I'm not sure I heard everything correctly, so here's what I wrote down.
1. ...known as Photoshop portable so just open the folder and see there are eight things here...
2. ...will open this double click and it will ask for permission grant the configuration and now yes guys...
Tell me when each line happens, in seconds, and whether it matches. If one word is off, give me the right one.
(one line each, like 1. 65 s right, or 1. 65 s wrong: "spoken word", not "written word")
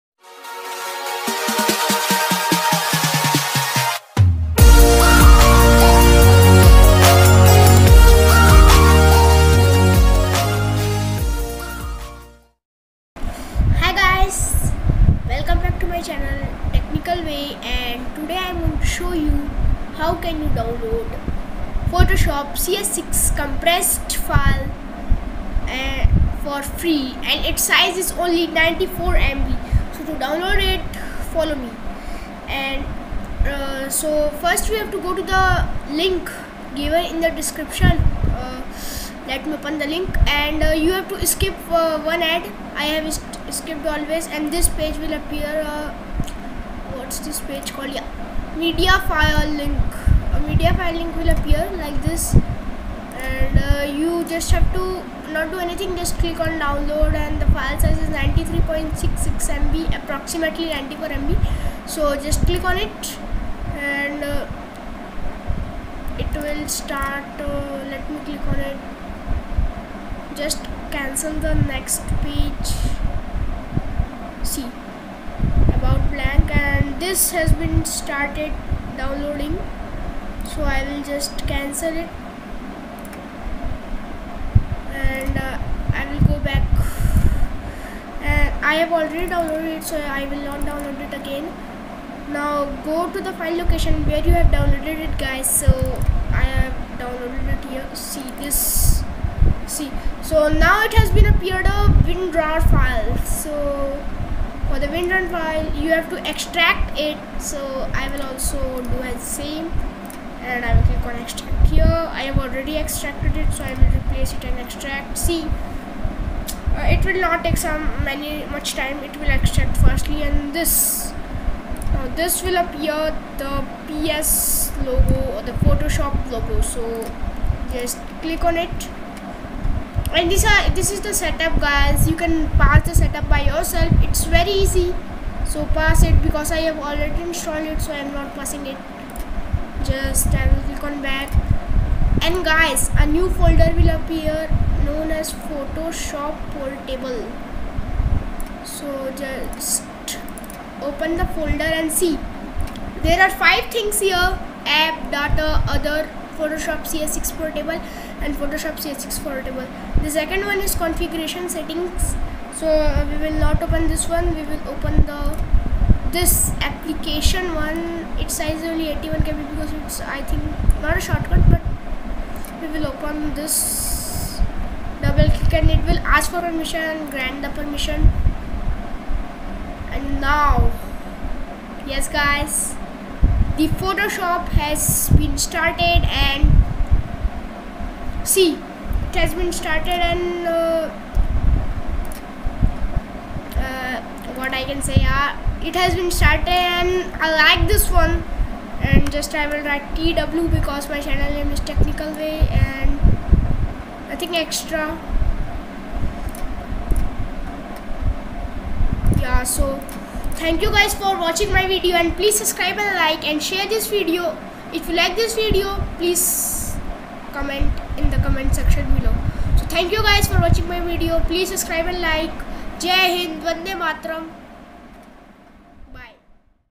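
1. 144 s wrong: "five", not "eight"
2. 172 s wrong: "permission", not "configuration".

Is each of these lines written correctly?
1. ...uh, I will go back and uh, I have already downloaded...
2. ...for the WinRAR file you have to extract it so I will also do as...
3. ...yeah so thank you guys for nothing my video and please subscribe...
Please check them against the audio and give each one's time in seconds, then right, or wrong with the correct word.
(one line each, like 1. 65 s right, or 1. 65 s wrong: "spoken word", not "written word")
1. 85 s right
2. 104 s right
3. 209 s wrong: "watching", not "nothing".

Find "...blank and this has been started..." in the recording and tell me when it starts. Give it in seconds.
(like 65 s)
76 s.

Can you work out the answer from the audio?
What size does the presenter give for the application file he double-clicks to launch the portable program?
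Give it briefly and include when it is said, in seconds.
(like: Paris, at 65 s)
81 KB, at 168 s.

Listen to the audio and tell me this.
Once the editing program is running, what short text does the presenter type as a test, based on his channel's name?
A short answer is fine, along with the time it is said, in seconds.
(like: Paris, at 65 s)
TW, at 199 s.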